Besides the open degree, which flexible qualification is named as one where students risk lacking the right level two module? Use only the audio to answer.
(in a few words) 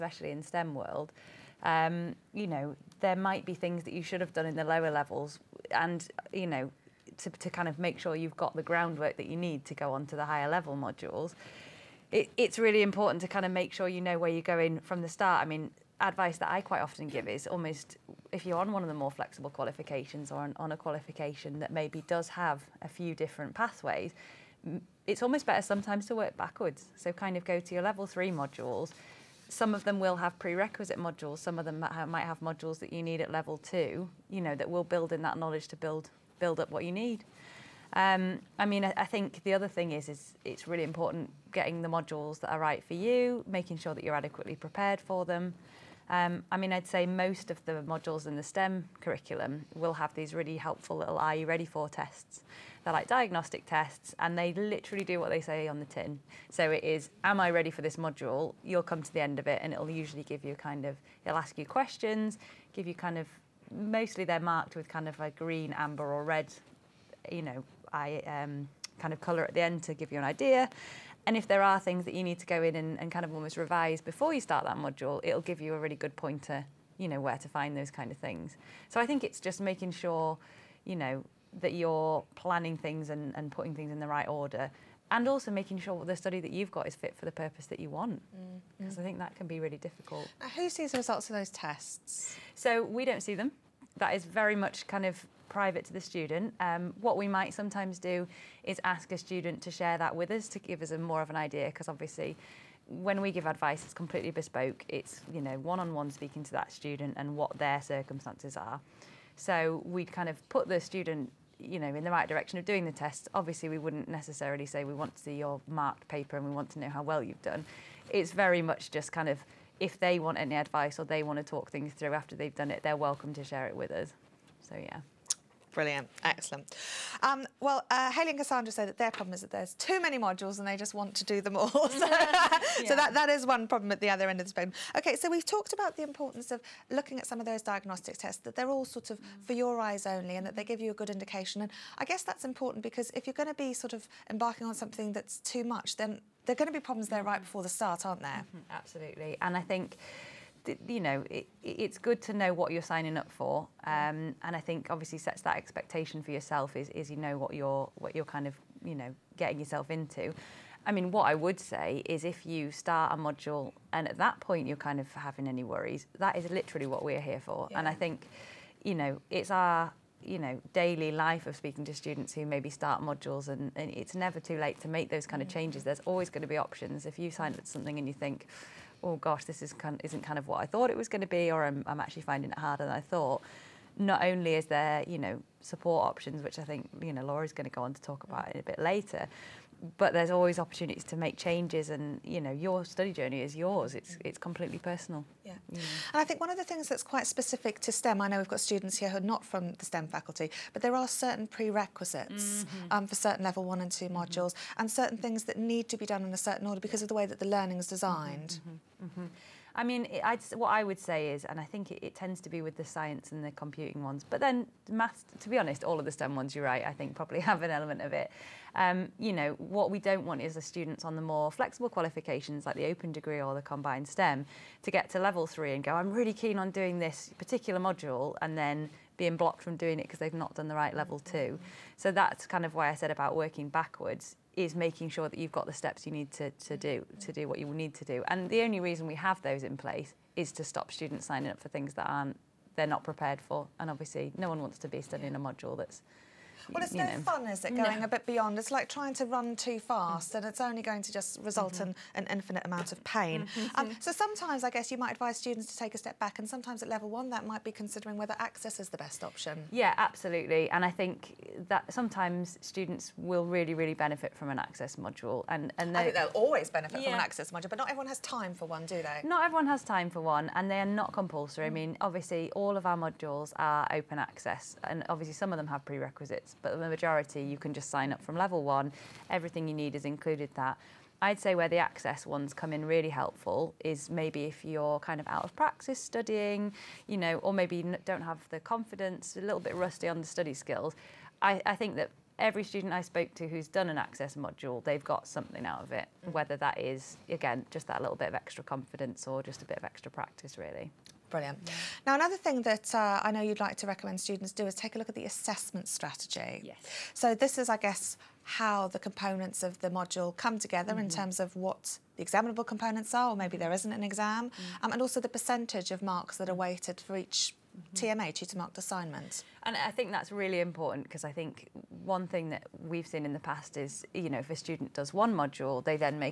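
combined STEM.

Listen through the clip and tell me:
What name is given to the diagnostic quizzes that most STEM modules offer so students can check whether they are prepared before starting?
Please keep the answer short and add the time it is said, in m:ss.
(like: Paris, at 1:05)
Are You Ready For tests, at 0:51.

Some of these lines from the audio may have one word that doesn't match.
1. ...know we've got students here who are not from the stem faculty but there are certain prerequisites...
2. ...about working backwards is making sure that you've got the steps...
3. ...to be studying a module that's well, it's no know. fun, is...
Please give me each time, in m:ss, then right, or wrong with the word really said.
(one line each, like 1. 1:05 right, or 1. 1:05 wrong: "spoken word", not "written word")
1. 3:18 right
2. 3:53 right
3. 4:04 right.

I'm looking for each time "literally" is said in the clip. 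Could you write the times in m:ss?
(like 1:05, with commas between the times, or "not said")
0:54, 2:46.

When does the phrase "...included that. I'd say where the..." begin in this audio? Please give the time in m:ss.
4:40.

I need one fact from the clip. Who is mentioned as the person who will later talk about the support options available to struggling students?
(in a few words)
Laura.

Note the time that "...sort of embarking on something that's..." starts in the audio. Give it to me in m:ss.
2:23.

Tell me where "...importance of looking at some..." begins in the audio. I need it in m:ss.
2:16.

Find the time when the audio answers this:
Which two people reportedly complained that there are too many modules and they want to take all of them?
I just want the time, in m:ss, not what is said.
2:08.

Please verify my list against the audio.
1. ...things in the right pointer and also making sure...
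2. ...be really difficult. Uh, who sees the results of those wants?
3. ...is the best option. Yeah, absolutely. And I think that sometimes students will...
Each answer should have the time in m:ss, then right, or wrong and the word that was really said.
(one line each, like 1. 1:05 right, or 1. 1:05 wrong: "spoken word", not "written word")
1. 1:23 wrong: "order", not "pointer"
2. 1:29 wrong: "tests", not "wants"
3. 4:18 right.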